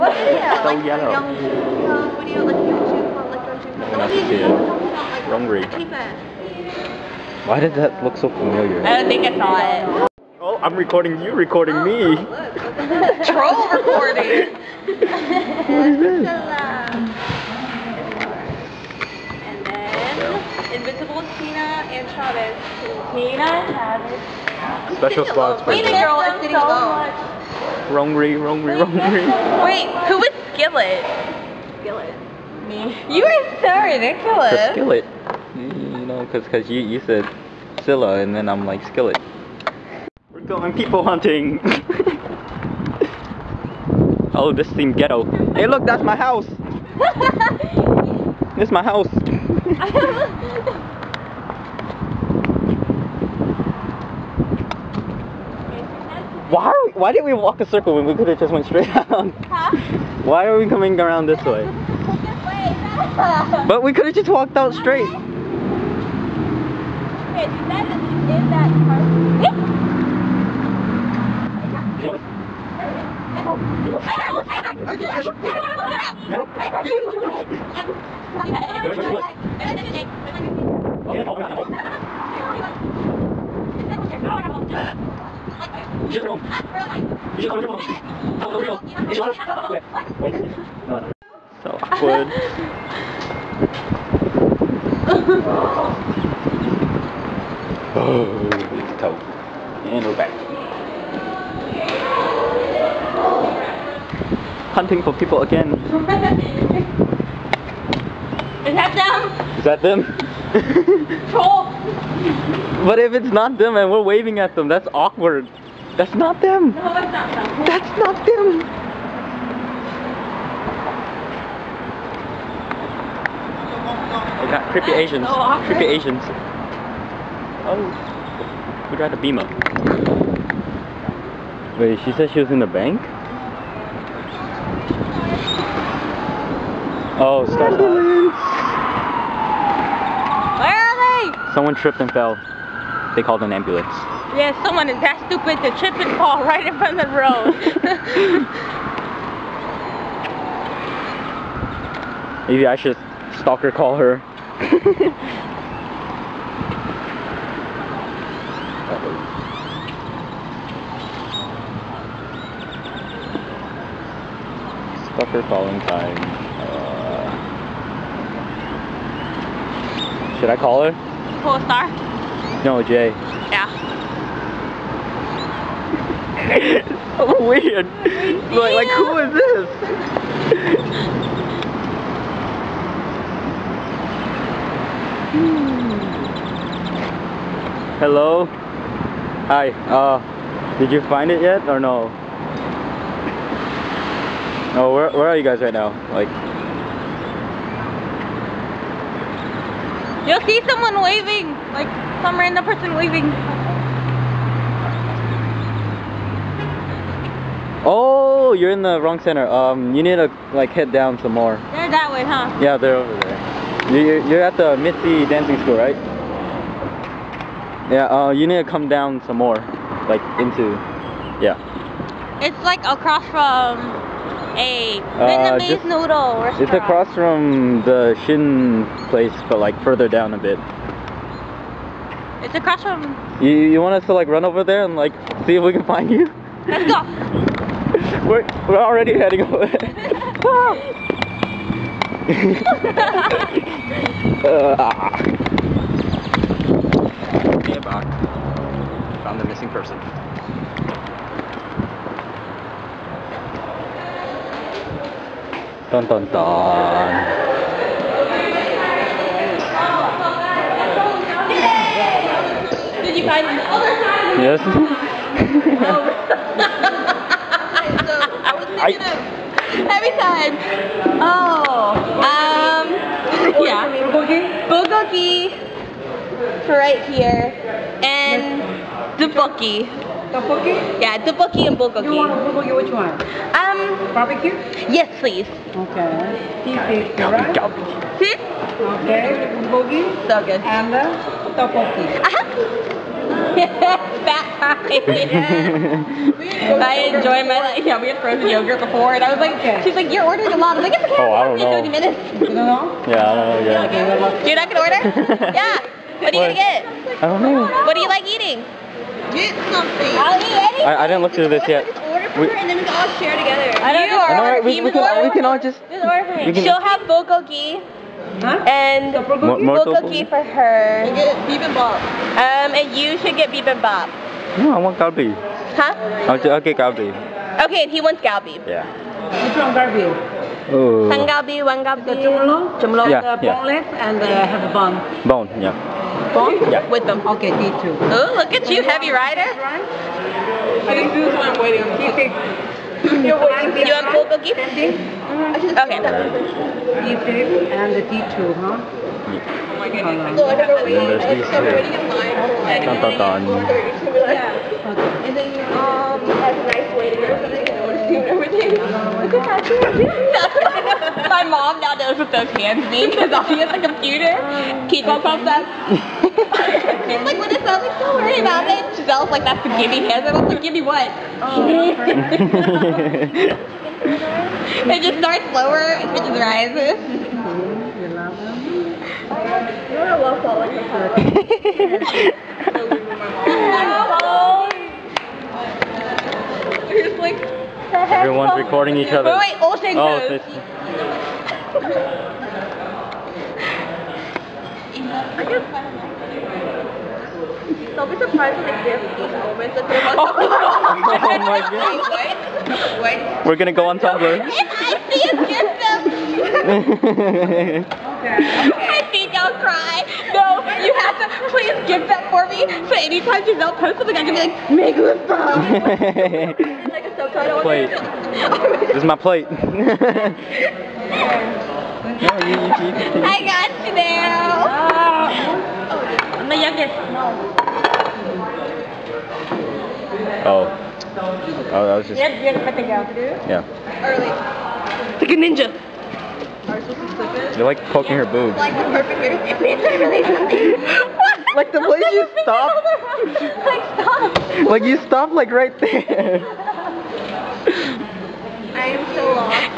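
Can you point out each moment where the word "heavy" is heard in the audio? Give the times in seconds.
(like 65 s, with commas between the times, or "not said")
338 s.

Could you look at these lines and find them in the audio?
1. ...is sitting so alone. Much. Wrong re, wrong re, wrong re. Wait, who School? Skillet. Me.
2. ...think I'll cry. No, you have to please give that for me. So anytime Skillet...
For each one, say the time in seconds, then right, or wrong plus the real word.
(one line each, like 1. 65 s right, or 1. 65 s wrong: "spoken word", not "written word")
1. 26 s wrong: "Skillet", not "School"
2. 409 s wrong: "Giselle", not "Skillet".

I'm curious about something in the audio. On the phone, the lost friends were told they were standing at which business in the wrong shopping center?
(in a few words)
Mitzi Dancing School.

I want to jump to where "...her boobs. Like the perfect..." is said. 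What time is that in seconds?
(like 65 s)
438 s.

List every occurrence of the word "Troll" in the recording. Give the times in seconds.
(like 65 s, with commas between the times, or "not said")
13 s, 111 s.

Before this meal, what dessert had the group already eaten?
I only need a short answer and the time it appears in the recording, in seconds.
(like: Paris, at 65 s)
Frozen yogurt, at 298 s.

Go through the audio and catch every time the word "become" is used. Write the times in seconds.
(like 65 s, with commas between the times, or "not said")
not said.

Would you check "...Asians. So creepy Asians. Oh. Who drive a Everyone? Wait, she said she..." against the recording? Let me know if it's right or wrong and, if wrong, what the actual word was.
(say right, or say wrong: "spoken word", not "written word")
wrong: "Beamer", not "Everyone".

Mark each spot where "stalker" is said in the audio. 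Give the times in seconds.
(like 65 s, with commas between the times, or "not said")
153 s, 165 s.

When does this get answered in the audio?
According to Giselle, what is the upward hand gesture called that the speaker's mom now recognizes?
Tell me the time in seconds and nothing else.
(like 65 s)
369 s.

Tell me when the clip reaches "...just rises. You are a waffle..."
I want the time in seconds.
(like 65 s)
376 s.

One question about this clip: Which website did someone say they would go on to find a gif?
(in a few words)
Tumblr.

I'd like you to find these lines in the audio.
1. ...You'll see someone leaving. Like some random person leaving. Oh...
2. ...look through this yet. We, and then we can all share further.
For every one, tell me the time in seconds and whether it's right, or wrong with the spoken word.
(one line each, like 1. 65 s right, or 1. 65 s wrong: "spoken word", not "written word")
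1. 200 s wrong: "waving", not "leaving"
2. 311 s wrong: "together", not "further".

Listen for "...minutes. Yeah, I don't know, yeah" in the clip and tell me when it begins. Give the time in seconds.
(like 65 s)
301 s.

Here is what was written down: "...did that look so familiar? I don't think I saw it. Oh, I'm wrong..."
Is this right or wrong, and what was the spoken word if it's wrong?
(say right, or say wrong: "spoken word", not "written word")
wrong: "recording", not "wrong".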